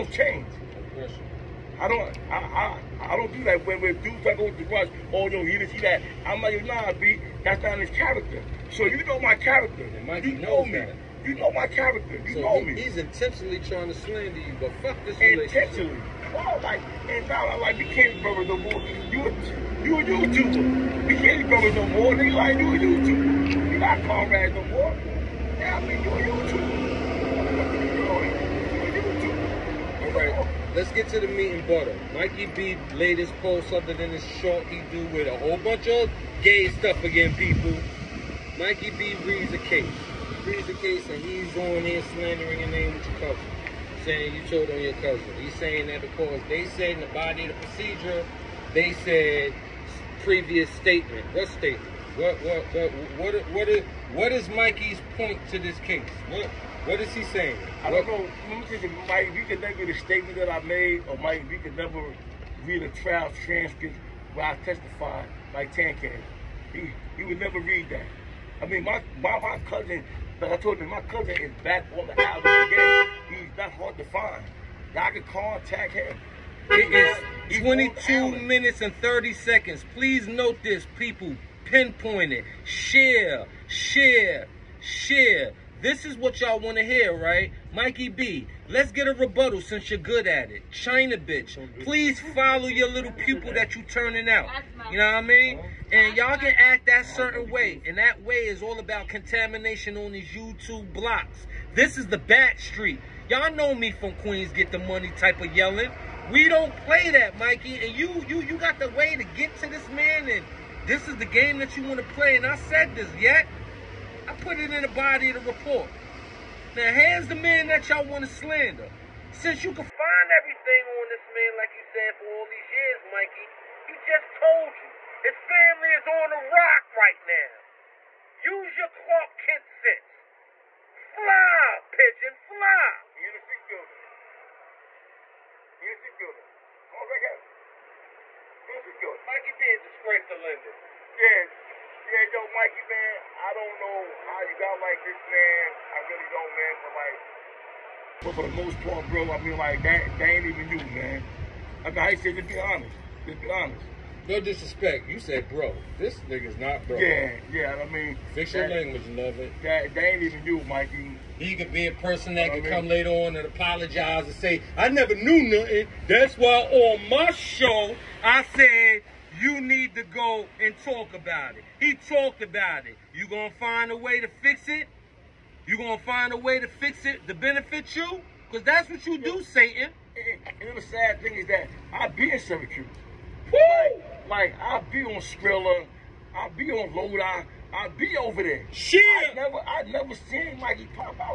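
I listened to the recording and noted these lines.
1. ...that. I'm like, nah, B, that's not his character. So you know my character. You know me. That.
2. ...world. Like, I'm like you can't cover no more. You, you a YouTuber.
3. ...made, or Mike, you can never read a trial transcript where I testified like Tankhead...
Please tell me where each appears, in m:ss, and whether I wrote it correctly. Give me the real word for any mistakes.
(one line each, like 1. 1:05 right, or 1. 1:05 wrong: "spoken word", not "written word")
1. 0:05 right
2. 0:16 right
3. 1:00 right.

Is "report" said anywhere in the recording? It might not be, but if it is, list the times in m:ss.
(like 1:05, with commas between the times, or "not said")
1:55.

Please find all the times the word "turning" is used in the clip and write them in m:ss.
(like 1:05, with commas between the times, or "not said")
1:33.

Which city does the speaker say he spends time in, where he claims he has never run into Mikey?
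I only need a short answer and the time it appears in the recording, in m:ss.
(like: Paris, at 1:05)
Syracuse, at 3:02.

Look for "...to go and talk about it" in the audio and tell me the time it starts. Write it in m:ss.
2:49.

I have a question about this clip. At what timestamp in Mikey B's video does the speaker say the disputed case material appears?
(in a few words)
22 minutes and 30 seconds.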